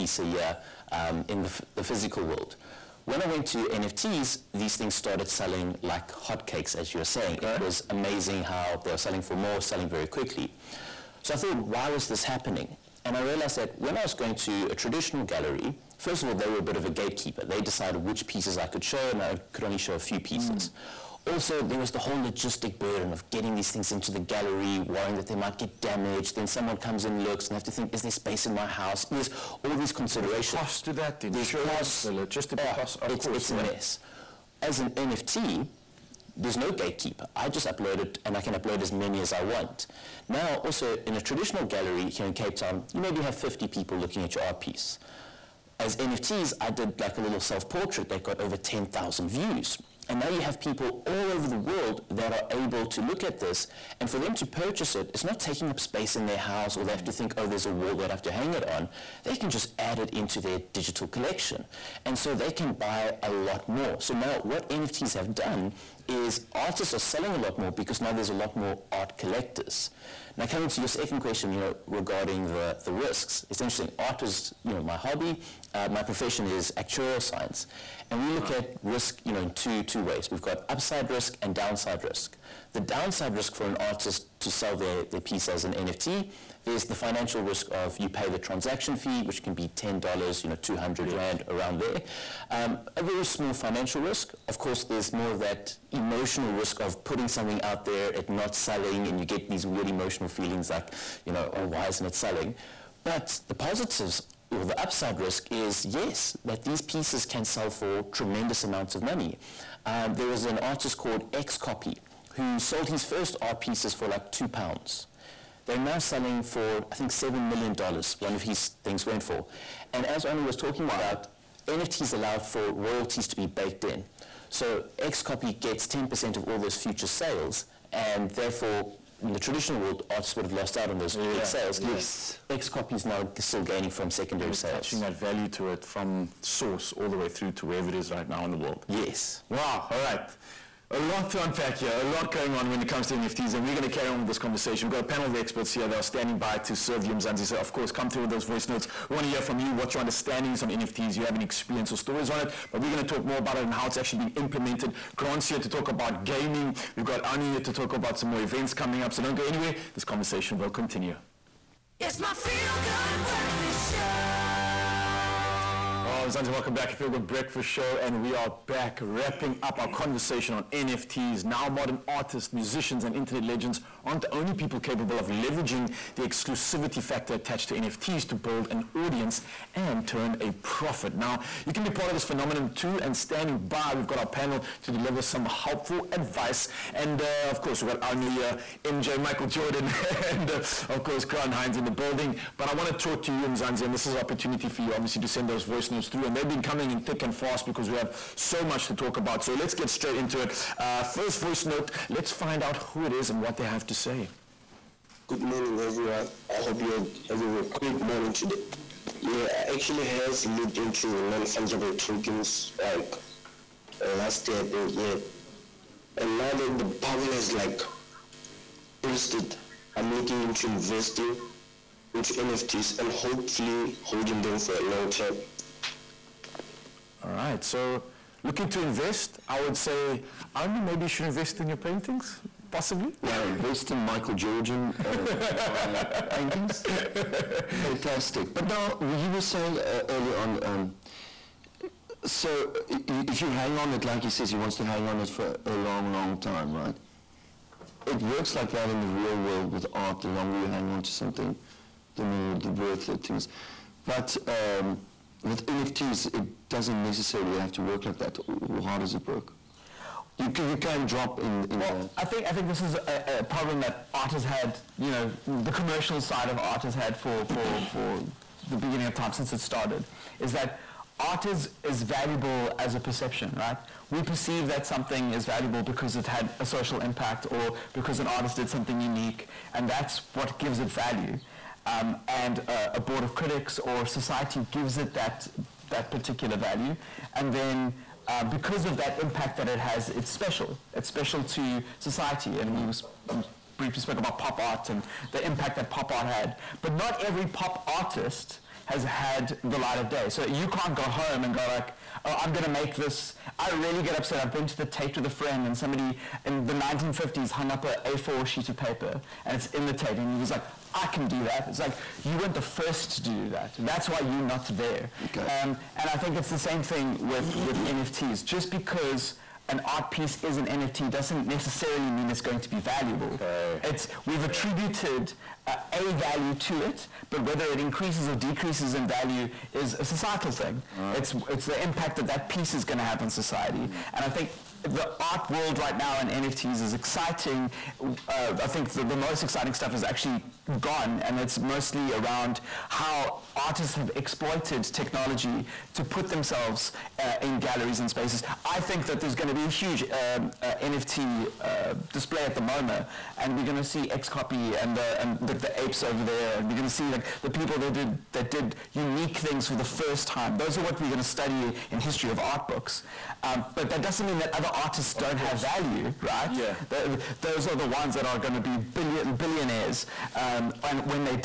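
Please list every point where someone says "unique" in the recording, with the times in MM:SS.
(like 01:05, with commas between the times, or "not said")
04:39, 05:58.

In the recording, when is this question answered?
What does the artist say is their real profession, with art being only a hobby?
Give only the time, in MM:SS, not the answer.
01:16.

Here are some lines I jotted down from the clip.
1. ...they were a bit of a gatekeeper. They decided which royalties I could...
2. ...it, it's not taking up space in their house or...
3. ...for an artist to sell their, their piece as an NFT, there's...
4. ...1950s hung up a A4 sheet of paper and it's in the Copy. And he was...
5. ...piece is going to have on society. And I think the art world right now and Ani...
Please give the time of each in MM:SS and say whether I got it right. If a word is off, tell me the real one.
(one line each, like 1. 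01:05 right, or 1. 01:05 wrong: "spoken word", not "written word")
1. 00:16 wrong: "pieces", not "royalties"
2. 00:54 right
3. 01:23 right
4. 05:06 wrong: "Tate", not "Copy"
5. 05:32 wrong: "NFTs", not "Ani".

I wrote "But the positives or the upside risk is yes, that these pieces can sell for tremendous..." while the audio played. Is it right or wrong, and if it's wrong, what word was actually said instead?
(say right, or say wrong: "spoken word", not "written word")
right.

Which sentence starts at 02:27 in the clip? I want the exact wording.
So, of course, come through with those voice notes.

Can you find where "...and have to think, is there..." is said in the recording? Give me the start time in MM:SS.
00:27.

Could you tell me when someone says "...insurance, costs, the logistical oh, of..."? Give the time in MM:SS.
00:31.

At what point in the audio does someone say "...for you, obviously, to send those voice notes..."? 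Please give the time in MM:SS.
03:14.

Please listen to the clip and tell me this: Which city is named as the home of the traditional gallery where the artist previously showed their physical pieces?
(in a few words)
Cape Town.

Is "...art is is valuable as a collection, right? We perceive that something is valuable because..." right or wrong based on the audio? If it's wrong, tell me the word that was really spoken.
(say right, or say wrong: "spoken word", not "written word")
wrong: "perception", not "collection".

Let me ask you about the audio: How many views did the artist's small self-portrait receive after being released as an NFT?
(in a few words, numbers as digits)
over 10,000.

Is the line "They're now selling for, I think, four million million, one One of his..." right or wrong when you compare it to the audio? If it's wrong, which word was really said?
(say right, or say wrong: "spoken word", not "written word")
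wrong: "seven", not "four".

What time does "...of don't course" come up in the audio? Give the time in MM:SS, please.
06:05.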